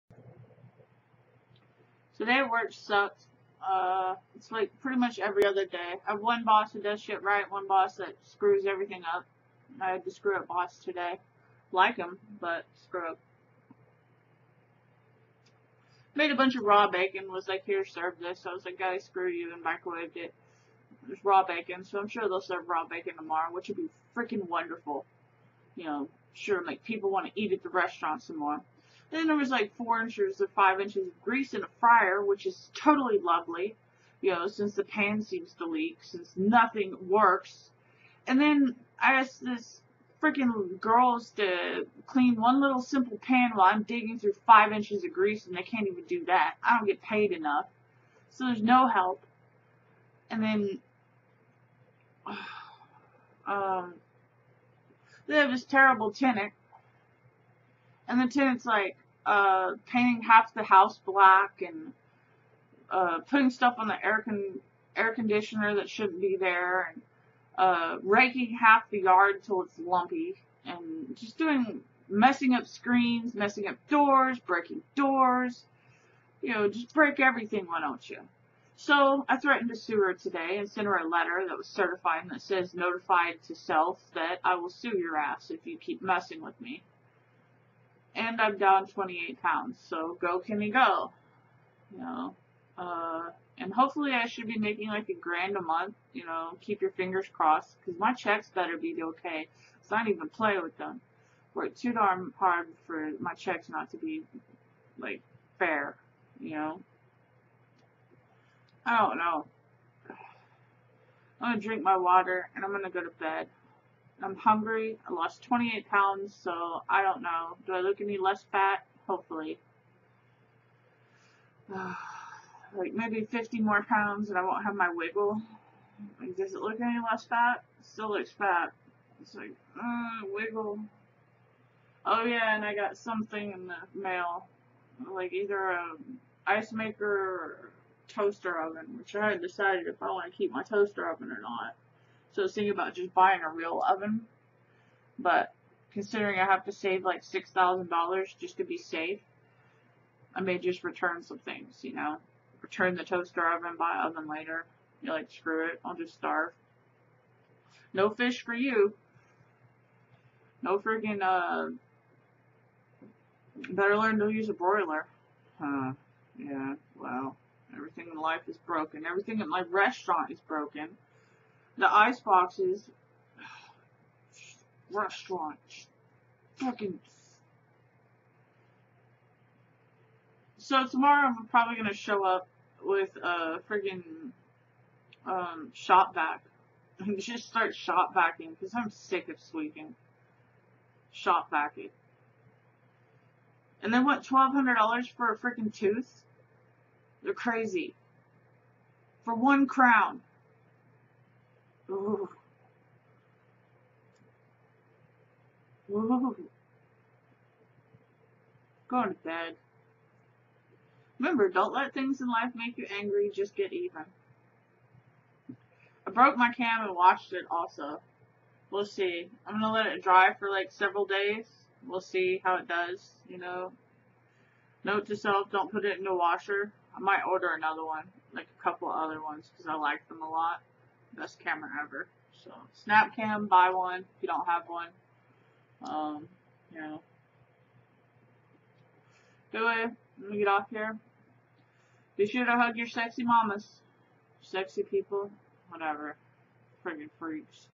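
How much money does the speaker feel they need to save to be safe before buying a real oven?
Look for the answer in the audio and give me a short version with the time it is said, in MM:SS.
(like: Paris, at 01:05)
$6,000, at 02:27.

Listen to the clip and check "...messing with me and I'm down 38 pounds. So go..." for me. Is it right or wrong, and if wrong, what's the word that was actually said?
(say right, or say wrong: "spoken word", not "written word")
wrong: "28", not "38".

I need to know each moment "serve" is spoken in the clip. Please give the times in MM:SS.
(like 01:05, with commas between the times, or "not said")
00:17, 00:22.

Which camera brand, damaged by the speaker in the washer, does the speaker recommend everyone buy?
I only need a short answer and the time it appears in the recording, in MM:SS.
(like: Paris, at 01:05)
Snapcam, at 03:52.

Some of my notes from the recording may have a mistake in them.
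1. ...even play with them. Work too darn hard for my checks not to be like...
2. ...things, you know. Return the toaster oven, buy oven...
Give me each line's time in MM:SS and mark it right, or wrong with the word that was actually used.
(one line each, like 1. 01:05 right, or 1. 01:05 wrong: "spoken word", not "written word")
1. 01:40 right
2. 02:31 right.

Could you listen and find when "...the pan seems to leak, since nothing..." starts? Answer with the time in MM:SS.
00:34.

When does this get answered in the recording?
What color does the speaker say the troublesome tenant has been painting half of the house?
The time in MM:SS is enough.
01:01.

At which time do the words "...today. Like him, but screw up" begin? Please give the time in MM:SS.
00:10.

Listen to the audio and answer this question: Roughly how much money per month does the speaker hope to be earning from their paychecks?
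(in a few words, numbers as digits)
A grand.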